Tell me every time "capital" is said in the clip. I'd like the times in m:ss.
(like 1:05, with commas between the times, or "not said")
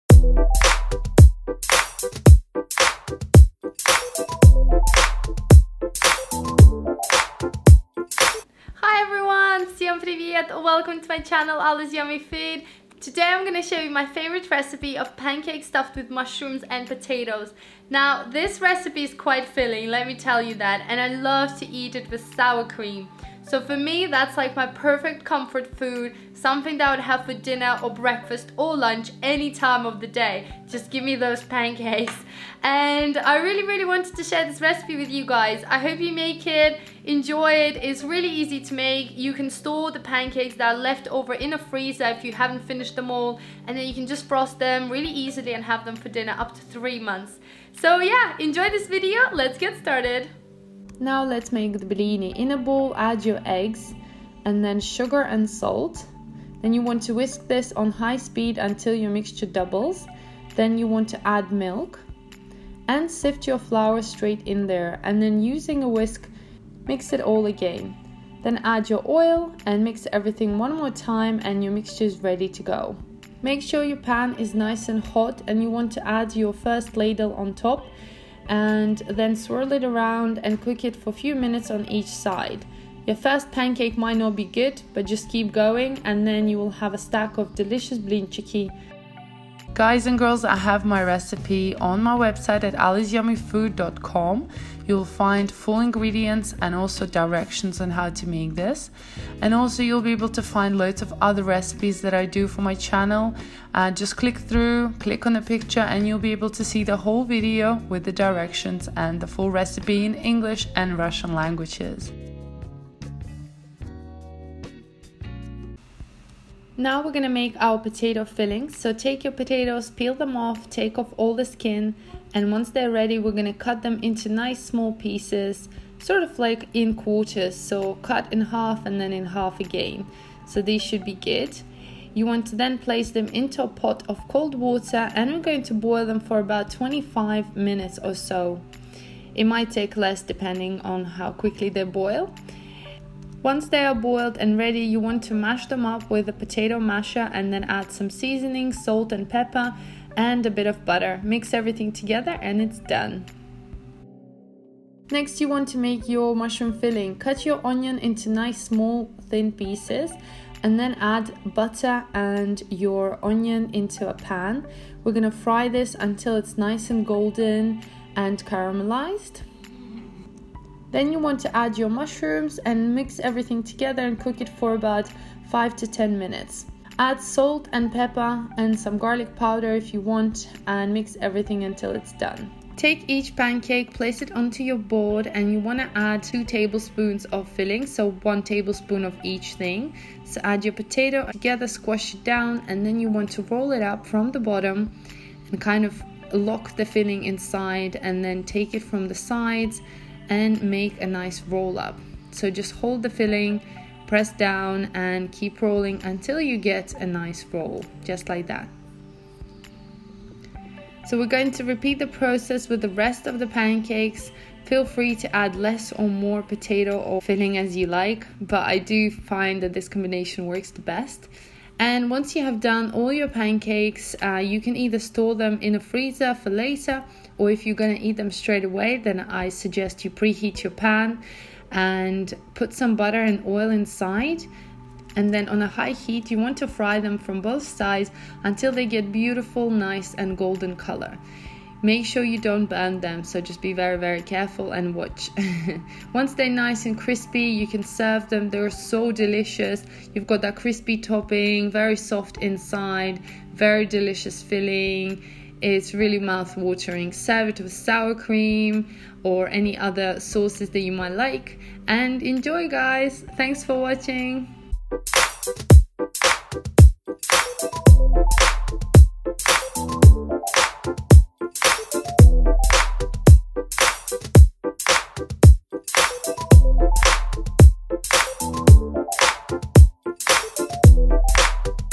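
not said.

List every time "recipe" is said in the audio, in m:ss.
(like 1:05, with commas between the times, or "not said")
0:14, 0:18, 0:34, 1:31, 1:41, 1:49.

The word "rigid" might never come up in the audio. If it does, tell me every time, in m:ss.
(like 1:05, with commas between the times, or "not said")
not said.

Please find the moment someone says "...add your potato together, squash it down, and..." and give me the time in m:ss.
3:10.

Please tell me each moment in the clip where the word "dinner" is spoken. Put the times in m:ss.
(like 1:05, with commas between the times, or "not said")
0:27, 0:46.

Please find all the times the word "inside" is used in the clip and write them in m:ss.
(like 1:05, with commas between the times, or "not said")
3:17, 3:53, 4:12.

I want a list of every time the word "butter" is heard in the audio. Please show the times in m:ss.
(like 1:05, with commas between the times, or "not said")
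2:30, 2:41, 3:52.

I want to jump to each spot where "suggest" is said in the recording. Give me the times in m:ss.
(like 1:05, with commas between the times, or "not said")
3:49.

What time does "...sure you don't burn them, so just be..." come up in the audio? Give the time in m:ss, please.
4:02.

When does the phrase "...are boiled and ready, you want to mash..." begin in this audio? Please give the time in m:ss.
2:23.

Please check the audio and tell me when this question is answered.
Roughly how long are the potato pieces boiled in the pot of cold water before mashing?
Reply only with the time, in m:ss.
2:16.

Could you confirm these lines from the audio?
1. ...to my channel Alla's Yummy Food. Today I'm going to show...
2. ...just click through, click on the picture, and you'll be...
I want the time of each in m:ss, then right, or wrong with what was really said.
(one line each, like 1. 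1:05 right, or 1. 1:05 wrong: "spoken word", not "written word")
1. 0:11 right
2. 1:43 right.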